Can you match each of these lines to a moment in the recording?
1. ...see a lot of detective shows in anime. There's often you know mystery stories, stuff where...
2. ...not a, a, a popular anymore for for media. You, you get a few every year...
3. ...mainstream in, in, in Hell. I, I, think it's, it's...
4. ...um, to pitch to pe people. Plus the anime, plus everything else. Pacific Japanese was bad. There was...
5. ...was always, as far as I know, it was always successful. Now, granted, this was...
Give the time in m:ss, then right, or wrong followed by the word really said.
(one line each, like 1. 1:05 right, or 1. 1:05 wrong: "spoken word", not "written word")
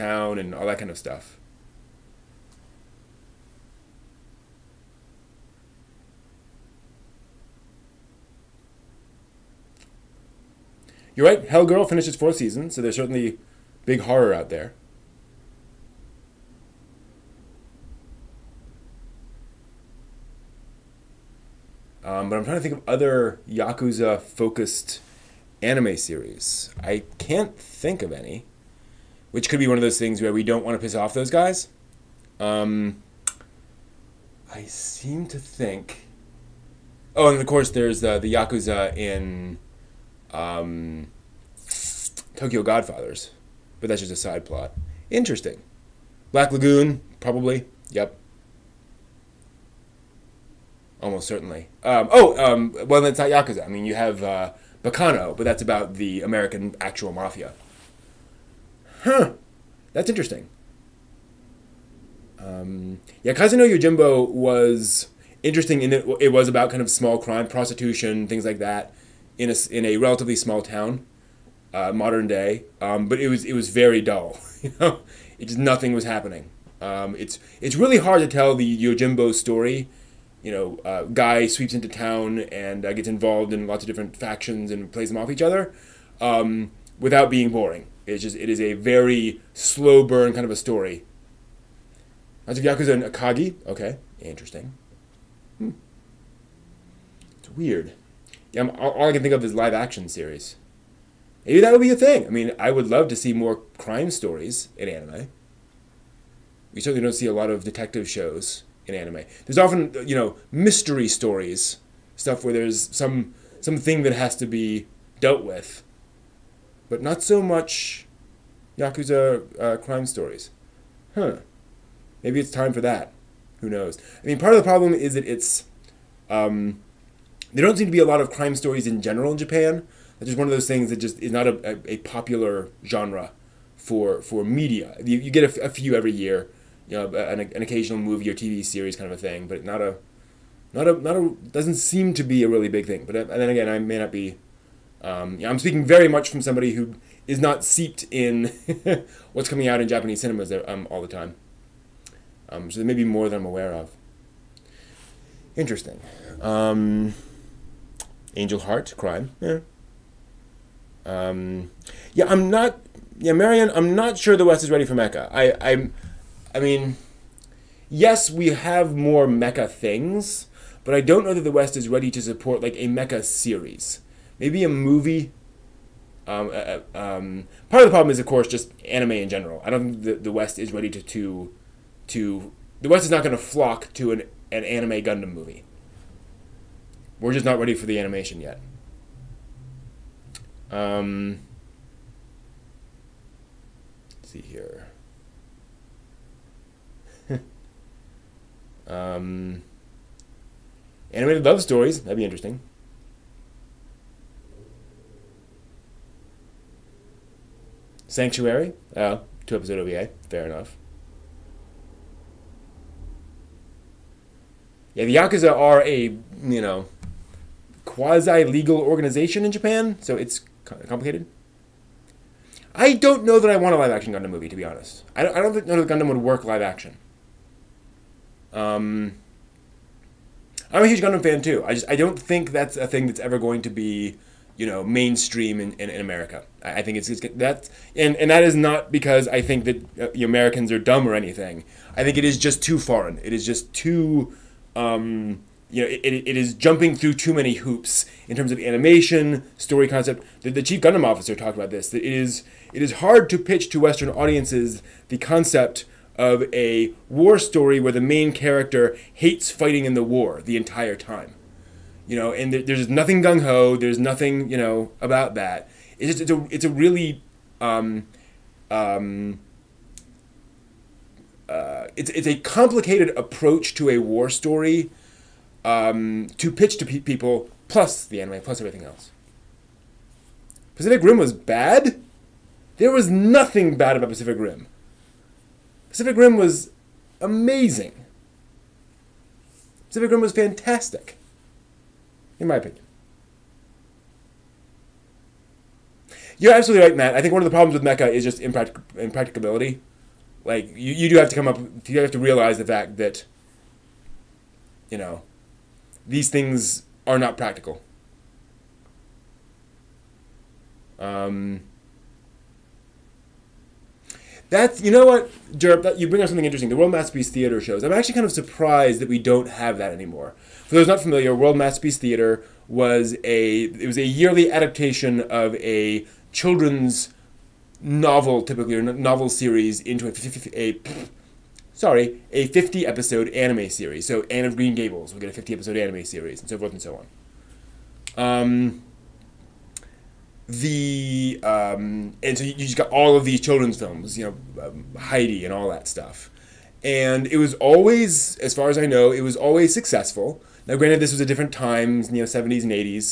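1. 1:47 right
2. 2:11 wrong: "genre", not "anymore"
3. 3:54 wrong: "America", not "Hell"
4. 4:35 wrong: "Rim", not "Japanese"
5. 5:47 right.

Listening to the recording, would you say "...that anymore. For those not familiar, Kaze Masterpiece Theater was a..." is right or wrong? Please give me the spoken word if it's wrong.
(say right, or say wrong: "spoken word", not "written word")
wrong: "World", not "Kaze".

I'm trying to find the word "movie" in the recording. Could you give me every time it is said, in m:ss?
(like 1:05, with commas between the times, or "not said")
2:17, 2:54, 3:05, 3:44.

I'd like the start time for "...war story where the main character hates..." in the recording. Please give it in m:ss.
4:17.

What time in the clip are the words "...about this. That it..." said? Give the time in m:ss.
4:11.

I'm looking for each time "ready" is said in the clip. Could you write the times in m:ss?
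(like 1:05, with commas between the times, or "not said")
2:44, 2:51, 3:00, 3:07.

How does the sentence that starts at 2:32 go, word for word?
Um, so there may be more than I'm aware of.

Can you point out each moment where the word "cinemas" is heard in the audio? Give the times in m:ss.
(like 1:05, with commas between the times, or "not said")
2:30.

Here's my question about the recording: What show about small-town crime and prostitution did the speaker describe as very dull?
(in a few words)
Kaze no Yojimbo.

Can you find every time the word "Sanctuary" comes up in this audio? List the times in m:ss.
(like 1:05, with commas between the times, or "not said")
3:28.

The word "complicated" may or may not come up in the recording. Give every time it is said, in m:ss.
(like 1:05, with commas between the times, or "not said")
3:40, 4:32.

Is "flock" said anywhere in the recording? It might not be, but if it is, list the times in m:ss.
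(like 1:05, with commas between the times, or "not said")
3:03.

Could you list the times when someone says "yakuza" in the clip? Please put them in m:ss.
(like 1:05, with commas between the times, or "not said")
0:23, 0:38, 0:53, 1:32, 1:58, 3:35.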